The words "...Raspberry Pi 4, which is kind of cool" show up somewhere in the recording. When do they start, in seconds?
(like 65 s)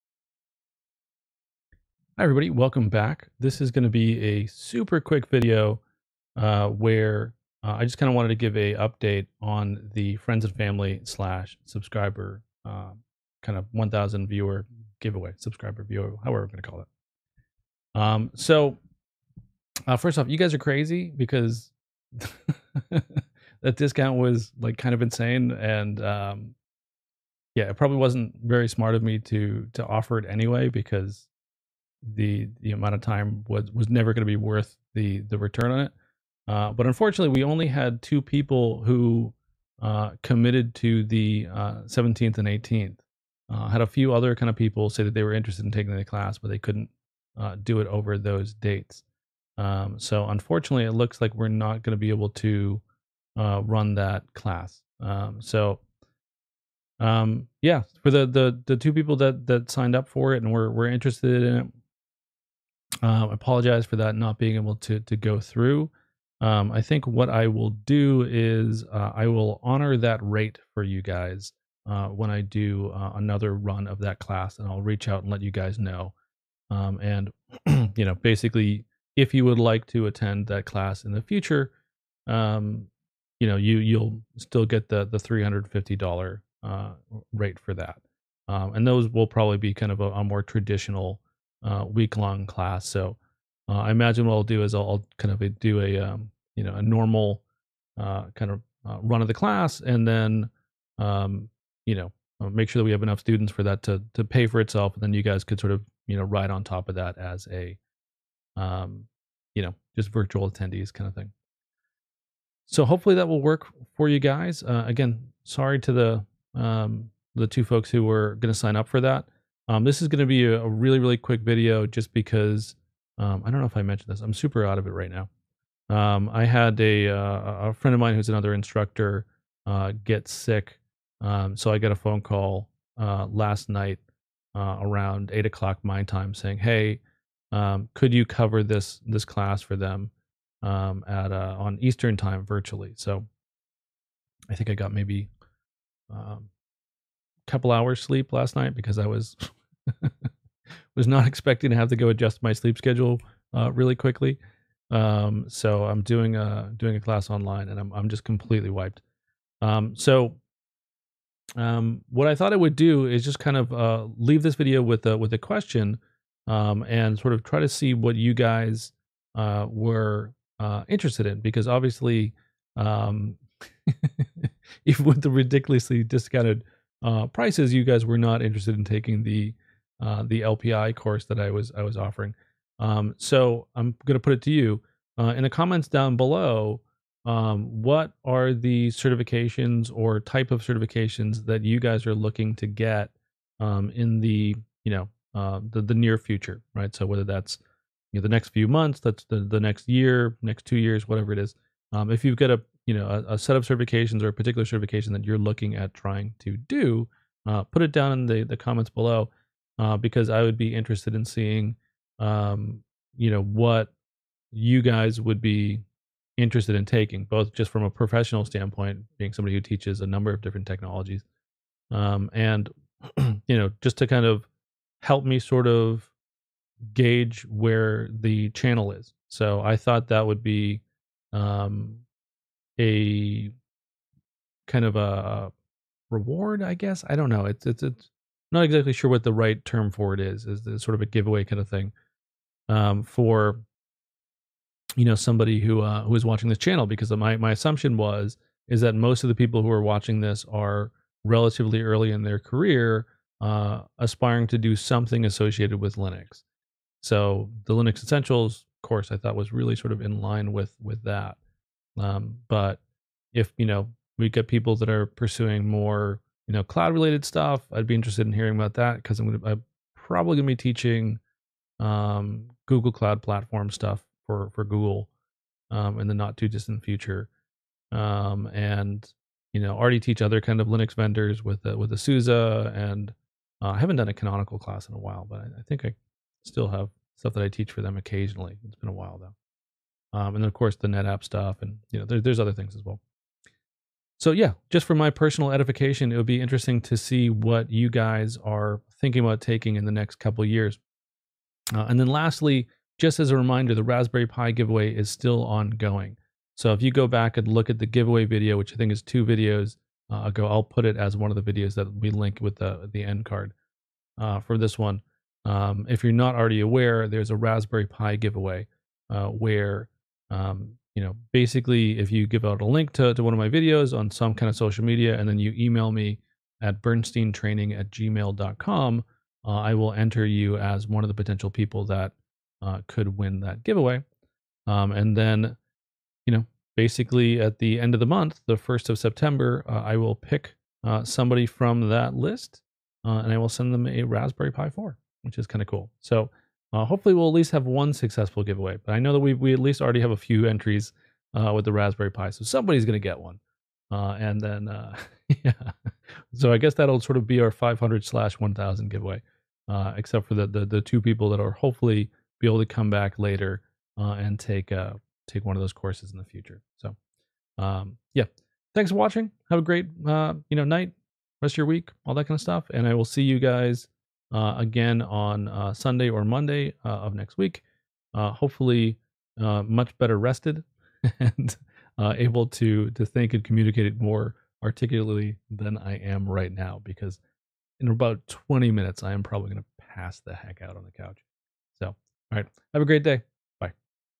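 344 s.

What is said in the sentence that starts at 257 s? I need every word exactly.
So the Linux Essentials course I thought was really sort of in line with with that.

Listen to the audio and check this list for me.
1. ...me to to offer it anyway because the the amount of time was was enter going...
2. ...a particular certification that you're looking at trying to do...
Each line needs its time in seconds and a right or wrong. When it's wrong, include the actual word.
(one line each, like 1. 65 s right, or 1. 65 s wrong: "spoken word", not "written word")
1. 29 s wrong: "never", not "enter"
2. 204 s right.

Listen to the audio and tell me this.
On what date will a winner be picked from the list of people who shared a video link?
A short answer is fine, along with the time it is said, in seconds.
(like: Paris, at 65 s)
September 1, at 338 s.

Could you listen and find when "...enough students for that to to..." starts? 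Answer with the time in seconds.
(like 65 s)
103 s.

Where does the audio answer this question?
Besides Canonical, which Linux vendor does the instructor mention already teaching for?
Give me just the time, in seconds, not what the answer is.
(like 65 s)
281 s.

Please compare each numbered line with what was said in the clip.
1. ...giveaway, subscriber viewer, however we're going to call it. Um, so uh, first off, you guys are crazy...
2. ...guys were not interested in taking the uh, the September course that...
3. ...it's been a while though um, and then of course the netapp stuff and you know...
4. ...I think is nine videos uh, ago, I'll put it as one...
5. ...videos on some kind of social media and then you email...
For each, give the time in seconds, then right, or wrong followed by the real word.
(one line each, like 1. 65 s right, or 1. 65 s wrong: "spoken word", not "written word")
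1. 14 s right
2. 177 s wrong: "LPI", not "September"
3. 288 s right
4. 308 s wrong: "two", not "nine"
5. 323 s right.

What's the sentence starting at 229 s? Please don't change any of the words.
So I thought that would be um, a kind of a reward, I guess.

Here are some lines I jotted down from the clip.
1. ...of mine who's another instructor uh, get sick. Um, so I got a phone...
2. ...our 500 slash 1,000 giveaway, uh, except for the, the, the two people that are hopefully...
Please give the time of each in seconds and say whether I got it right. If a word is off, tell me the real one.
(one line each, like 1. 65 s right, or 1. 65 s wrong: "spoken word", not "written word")
1. 127 s right
2. 357 s right.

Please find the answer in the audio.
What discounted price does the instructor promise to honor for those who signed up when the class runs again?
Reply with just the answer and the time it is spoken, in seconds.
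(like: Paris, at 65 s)
$350, at 85 s.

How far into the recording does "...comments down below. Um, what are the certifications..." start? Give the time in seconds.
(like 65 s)
185 s.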